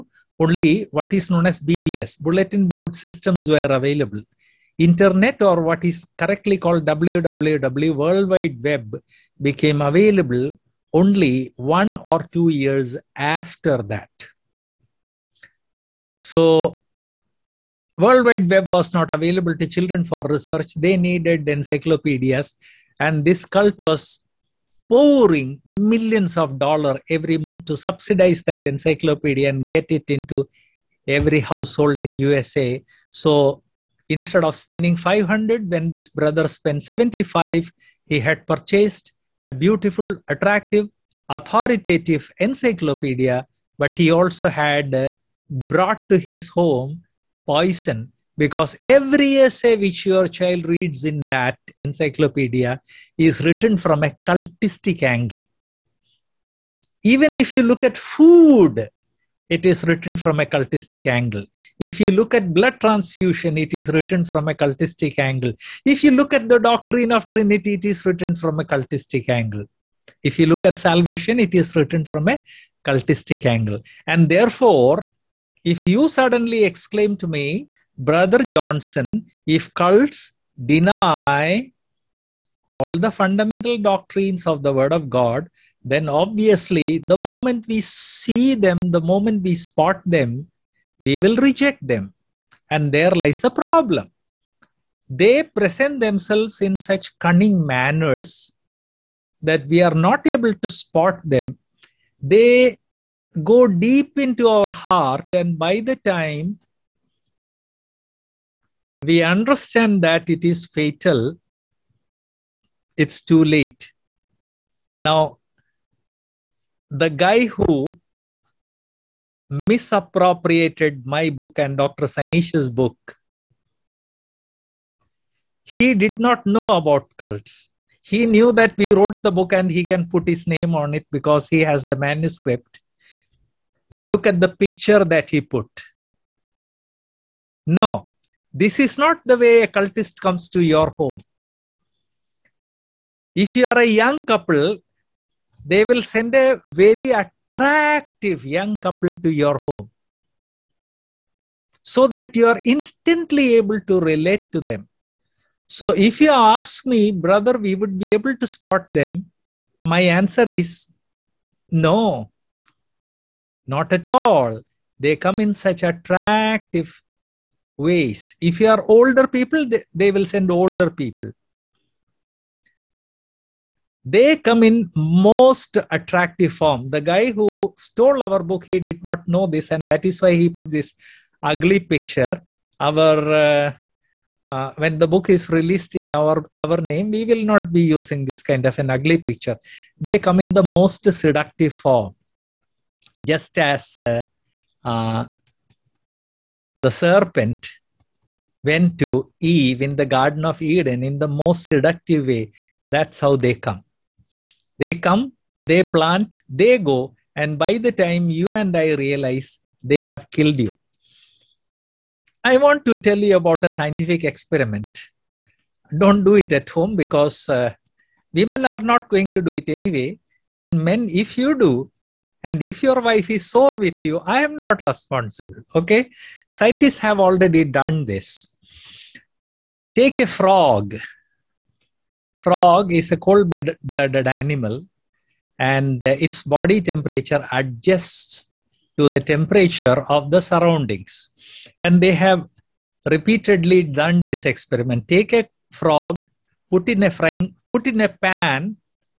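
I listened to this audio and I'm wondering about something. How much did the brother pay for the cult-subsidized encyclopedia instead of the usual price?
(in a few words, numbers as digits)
75.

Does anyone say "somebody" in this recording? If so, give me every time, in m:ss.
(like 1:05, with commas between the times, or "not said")
not said.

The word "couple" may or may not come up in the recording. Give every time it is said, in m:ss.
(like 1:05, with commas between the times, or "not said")
2:24, 2:28.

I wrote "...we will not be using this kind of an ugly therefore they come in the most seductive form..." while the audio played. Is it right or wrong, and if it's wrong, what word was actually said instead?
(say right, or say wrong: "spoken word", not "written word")
wrong: "picture", not "therefore".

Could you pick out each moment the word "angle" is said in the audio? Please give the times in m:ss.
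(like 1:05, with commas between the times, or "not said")
0:55, 1:01, 1:05, 1:09, 1:13.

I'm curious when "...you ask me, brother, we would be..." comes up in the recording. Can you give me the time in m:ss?
2:36.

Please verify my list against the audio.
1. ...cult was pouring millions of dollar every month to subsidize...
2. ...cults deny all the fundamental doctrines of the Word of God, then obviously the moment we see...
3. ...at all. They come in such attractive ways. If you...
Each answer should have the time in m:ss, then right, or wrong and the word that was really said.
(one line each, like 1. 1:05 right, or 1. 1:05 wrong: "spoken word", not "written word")
1. 0:23 right
2. 1:19 right
3. 2:43 right.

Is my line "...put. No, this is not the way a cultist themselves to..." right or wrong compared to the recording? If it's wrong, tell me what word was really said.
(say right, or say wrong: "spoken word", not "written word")
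wrong: "comes", not "themselves".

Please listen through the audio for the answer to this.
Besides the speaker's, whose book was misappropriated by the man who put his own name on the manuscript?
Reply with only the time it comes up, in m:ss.
2:01.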